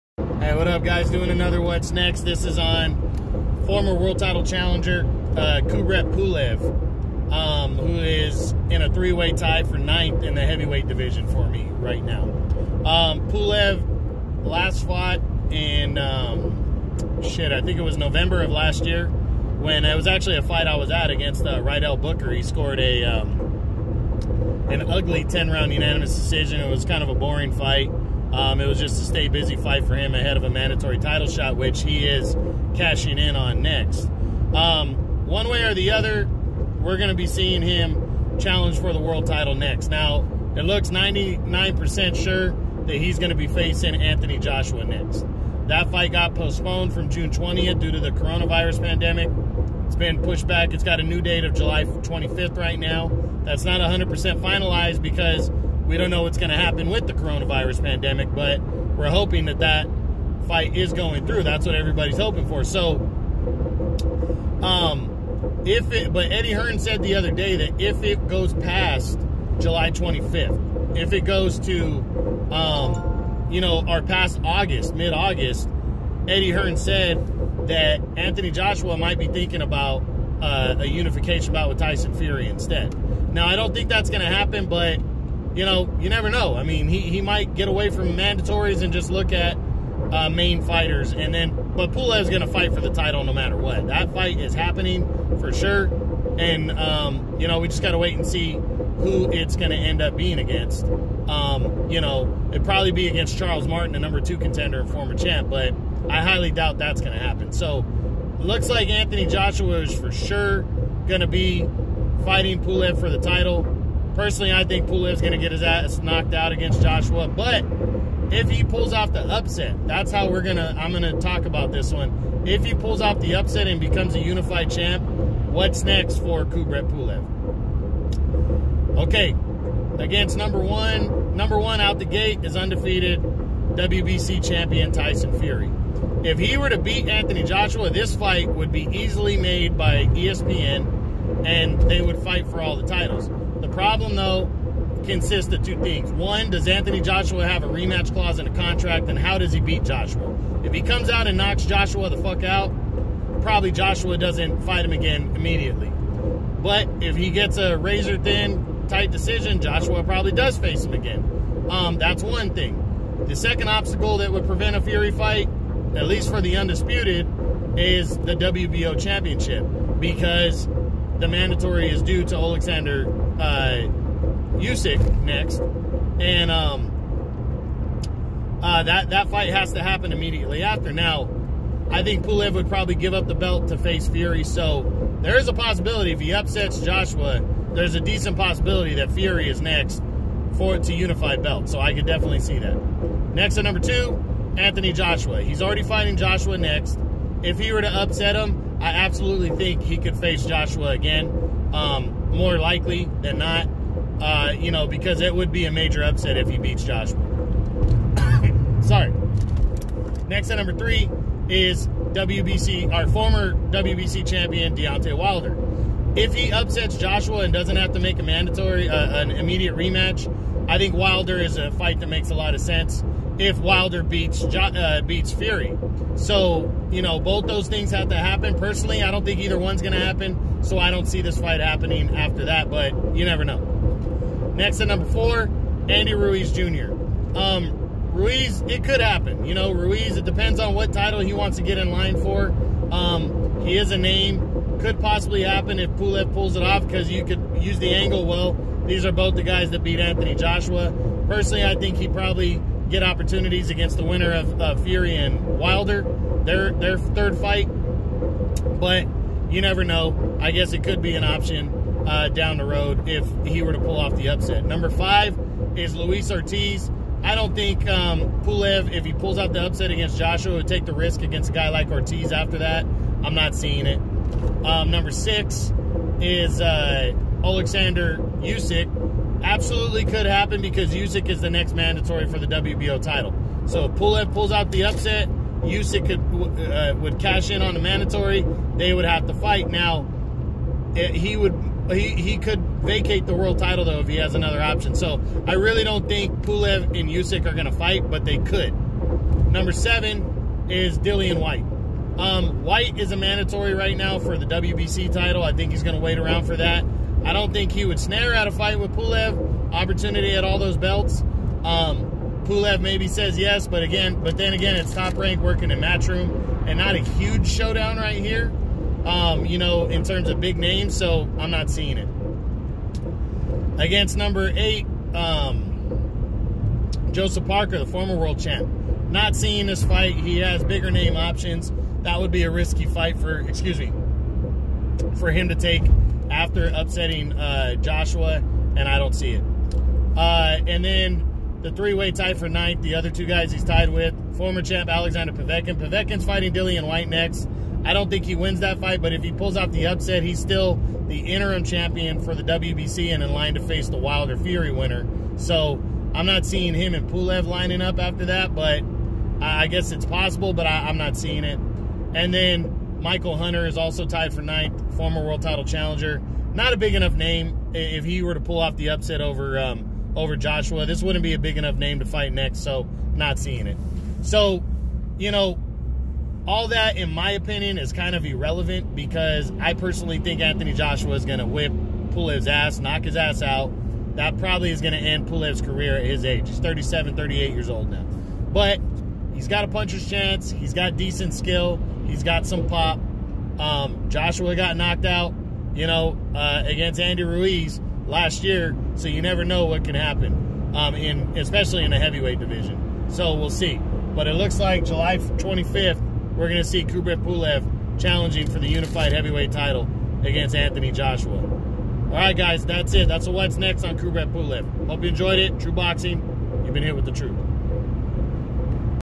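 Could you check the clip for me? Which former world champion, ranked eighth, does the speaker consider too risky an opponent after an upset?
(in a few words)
Joseph Parker.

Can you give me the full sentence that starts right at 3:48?
Personally, I don't think either one's going to happen.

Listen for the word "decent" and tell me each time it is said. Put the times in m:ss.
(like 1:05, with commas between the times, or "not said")
3:08, 6:30.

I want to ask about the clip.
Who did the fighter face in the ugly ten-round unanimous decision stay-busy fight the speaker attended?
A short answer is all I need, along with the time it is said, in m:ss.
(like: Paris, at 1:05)
Rydell Booker, at 0:21.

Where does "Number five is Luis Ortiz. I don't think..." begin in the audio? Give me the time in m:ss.
4:24.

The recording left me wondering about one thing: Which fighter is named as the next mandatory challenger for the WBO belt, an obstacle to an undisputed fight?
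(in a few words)
Alexander Usyk.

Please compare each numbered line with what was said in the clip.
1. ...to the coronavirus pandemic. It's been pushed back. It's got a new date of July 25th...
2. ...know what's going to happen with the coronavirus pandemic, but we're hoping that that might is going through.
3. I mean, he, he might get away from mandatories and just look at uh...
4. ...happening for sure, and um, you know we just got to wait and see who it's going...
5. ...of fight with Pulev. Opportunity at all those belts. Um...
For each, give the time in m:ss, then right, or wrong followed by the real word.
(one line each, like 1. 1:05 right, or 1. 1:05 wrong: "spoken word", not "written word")
1. 0:47 right
2. 0:56 wrong: "fight", not "might"
3. 1:26 right
4. 1:34 right
5. 5:08 right.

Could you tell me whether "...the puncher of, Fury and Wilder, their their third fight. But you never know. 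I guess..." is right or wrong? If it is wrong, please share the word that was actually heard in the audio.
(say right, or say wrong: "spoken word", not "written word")
wrong: "winner", not "puncher".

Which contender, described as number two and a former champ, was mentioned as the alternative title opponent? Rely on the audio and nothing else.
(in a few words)
Charles Martin.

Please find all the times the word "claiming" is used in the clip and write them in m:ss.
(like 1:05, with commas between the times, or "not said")
not said.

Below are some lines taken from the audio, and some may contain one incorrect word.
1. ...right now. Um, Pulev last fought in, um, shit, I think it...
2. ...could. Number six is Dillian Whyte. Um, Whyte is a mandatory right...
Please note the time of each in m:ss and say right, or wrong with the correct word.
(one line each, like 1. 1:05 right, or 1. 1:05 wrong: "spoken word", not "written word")
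1. 0:11 right
2. 4:58 wrong: "seven", not "six".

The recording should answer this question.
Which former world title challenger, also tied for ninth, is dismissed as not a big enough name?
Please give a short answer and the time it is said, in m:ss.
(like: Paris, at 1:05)
Michael Hunter, at 6:03.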